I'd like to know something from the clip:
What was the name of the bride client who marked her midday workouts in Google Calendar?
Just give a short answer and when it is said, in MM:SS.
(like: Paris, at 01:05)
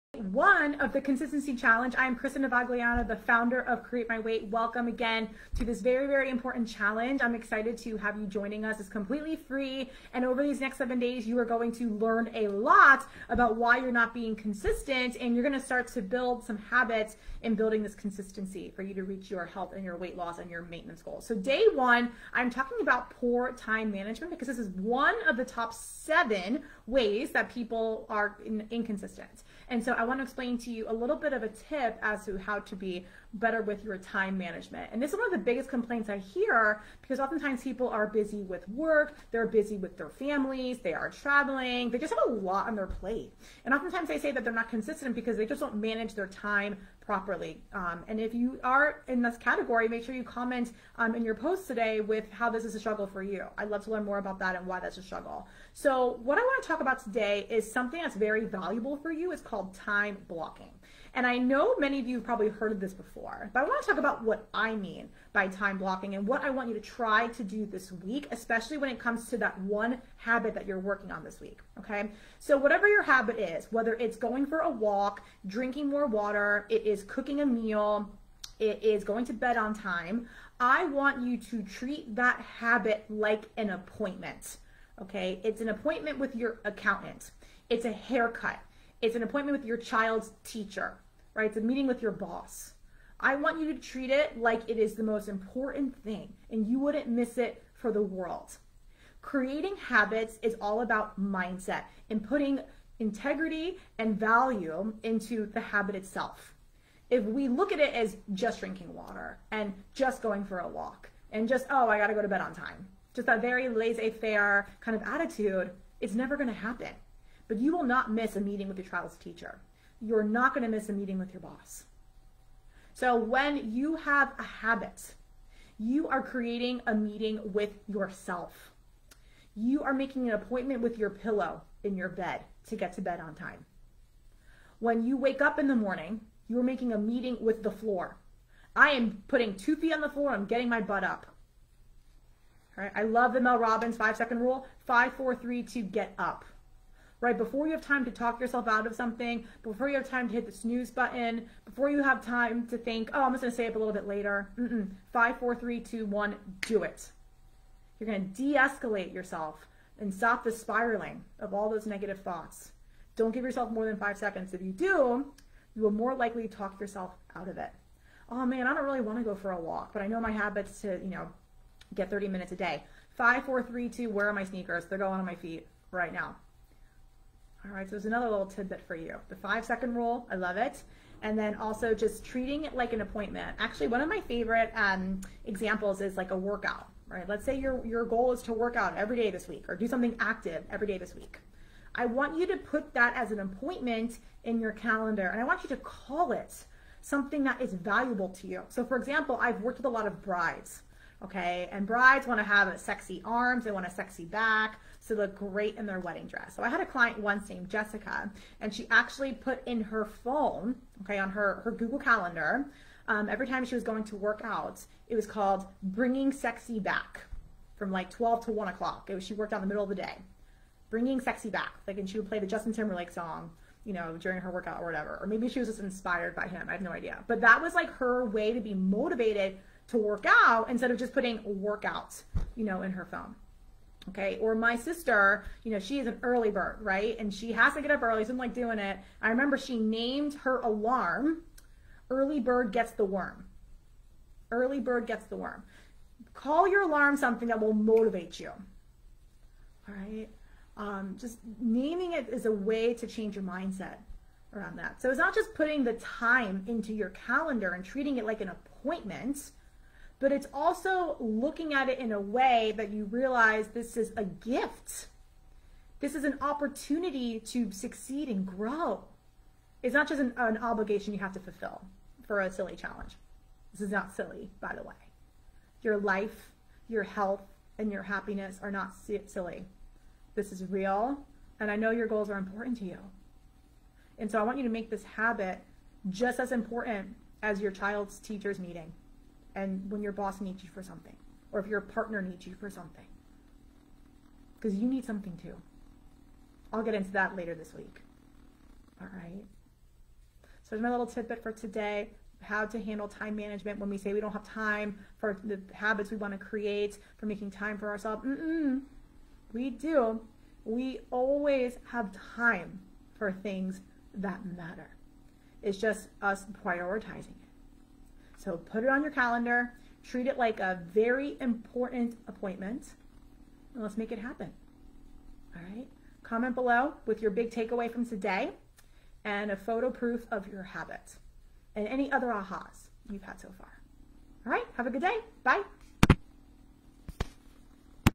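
Jessica, at 03:27.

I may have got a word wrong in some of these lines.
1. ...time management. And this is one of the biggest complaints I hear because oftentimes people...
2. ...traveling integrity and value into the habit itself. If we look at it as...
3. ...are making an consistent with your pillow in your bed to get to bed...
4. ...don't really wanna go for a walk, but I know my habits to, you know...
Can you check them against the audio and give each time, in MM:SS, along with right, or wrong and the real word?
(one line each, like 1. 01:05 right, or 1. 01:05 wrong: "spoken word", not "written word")
1. 00:33 right
2. 01:42 wrong: "putting", not "traveling"
3. 02:09 wrong: "appointment", not "consistent"
4. 02:48 right.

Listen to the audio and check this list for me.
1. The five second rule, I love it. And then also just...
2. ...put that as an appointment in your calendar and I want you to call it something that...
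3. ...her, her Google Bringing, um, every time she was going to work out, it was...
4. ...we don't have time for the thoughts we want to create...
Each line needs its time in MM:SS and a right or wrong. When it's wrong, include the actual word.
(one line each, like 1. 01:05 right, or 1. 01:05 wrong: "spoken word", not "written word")
1. 02:59 right
2. 03:12 right
3. 03:31 wrong: "Calendar", not "Bringing"
4. 05:04 wrong: "habits", not "thoughts".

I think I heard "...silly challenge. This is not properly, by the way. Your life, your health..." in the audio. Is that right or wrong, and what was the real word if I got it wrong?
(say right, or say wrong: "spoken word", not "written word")
wrong: "silly", not "properly".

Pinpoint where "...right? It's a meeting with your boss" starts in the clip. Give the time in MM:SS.
01:31.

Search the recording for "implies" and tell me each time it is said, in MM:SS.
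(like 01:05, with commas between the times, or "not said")
not said.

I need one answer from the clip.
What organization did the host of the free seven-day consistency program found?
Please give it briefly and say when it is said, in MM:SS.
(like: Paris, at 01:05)
Create My Weight, at 00:03.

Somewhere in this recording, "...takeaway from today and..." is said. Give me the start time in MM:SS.
05:27.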